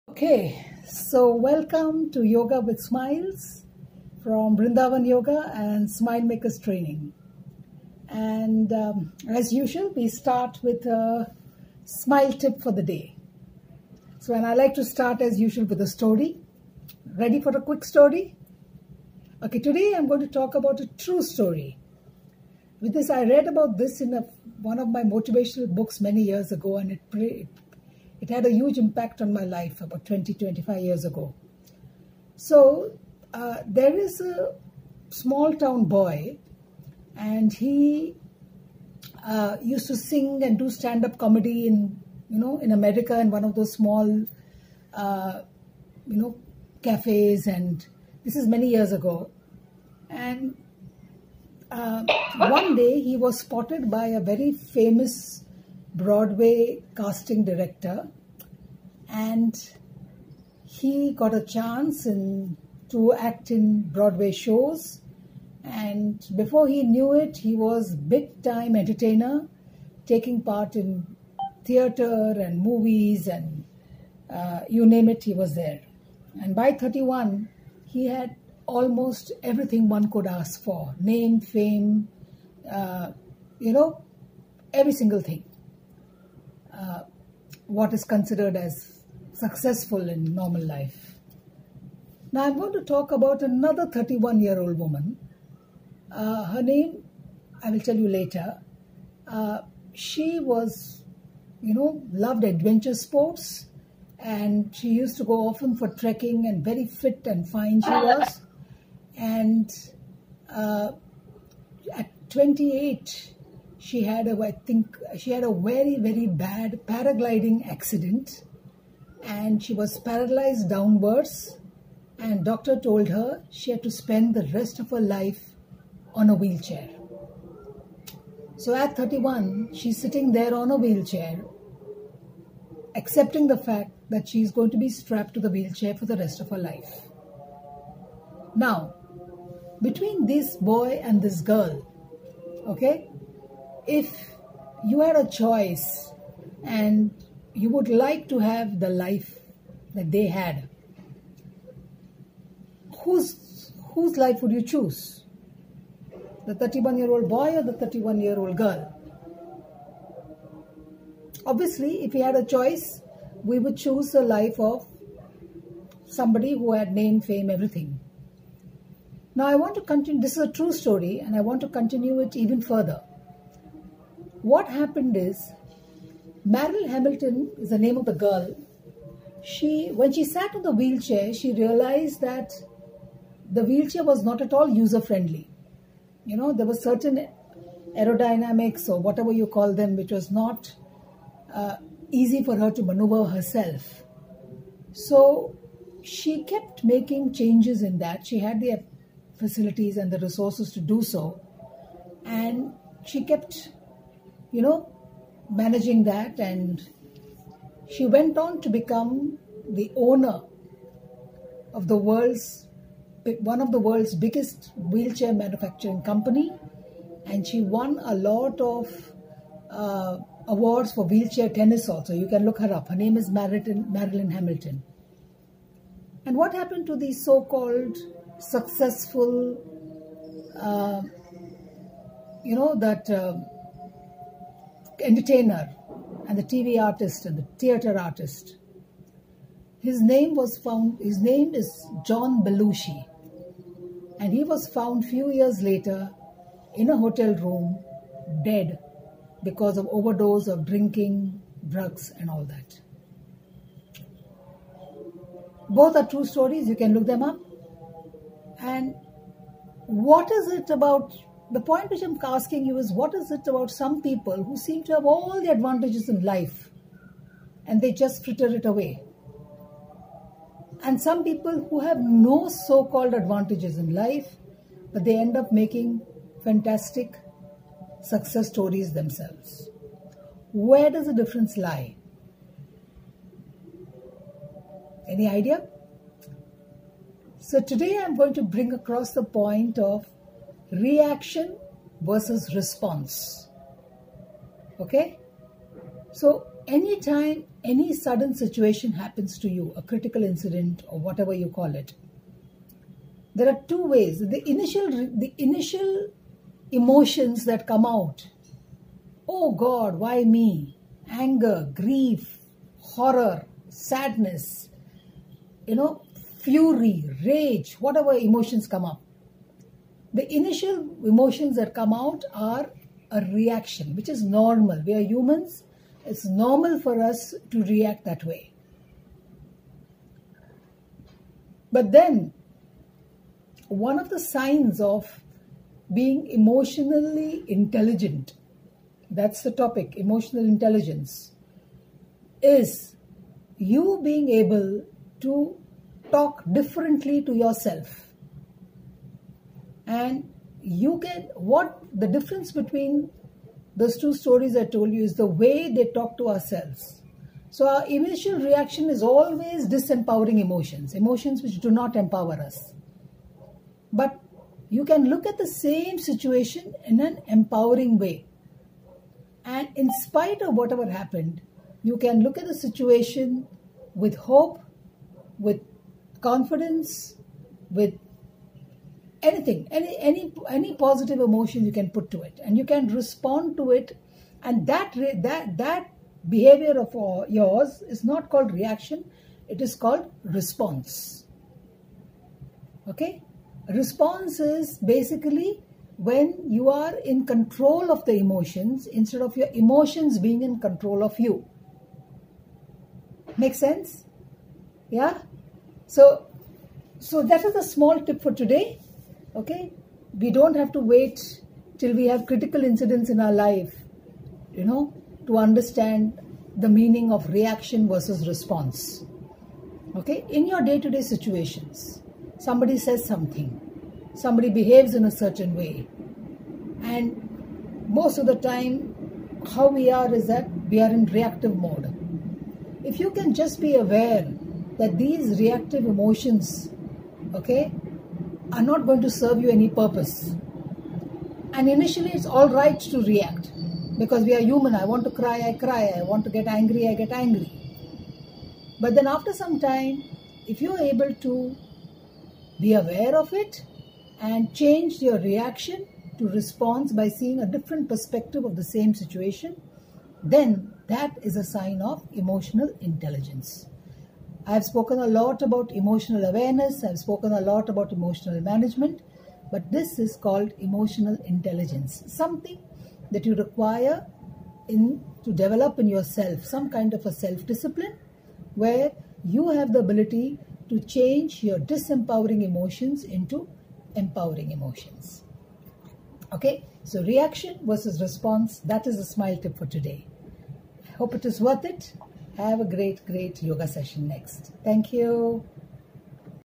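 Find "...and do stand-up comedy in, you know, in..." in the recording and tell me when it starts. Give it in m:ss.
0:40.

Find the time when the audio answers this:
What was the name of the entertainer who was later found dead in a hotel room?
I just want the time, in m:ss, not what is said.
4:02.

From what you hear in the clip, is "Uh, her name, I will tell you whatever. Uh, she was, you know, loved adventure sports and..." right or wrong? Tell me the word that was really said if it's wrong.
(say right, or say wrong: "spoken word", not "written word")
wrong: "later", not "whatever".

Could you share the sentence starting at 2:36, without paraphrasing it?
The 31-year-old boy or the 31-year-old girl?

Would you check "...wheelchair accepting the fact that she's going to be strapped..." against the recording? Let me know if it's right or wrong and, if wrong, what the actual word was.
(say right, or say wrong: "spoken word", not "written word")
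right.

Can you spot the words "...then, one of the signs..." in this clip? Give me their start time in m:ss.
5:31.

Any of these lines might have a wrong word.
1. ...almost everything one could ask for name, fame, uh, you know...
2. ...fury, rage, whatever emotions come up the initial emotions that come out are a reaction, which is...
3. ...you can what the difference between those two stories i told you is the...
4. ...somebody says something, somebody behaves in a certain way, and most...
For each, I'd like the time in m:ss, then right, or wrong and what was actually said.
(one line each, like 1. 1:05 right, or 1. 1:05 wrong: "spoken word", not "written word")
1. 1:18 right
2. 5:16 right
3. 5:50 right
4. 7:02 right.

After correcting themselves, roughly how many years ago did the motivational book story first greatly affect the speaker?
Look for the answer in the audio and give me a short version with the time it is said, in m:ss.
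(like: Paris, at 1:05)
25, at 0:30.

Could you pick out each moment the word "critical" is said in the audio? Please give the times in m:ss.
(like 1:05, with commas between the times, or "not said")
4:59, 6:52.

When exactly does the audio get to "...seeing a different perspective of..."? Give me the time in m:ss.
7:37.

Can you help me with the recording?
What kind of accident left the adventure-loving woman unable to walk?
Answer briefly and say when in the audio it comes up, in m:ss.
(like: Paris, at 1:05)
paragliding, at 1:56.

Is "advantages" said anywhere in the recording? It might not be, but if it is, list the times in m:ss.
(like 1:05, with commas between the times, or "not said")
4:25, 4:33.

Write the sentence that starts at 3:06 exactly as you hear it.
You know, there were certain aerodynamics or whatever you call them, which was not uh, easy for her to maneuver herself.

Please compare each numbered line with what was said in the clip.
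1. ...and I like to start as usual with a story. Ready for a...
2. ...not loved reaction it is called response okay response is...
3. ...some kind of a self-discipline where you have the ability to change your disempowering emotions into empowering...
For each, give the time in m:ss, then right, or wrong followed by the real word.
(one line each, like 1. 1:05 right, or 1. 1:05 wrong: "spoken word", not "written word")
1. 0:14 right
2. 6:28 wrong: "called", not "loved"
3. 7:56 right.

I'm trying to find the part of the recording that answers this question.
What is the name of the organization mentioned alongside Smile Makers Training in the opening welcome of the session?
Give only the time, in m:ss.
0:04.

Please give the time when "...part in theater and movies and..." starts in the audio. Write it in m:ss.
1:10.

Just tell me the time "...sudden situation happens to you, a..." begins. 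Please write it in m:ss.
4:57.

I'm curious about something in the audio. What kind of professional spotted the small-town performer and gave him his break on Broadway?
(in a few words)
casting director.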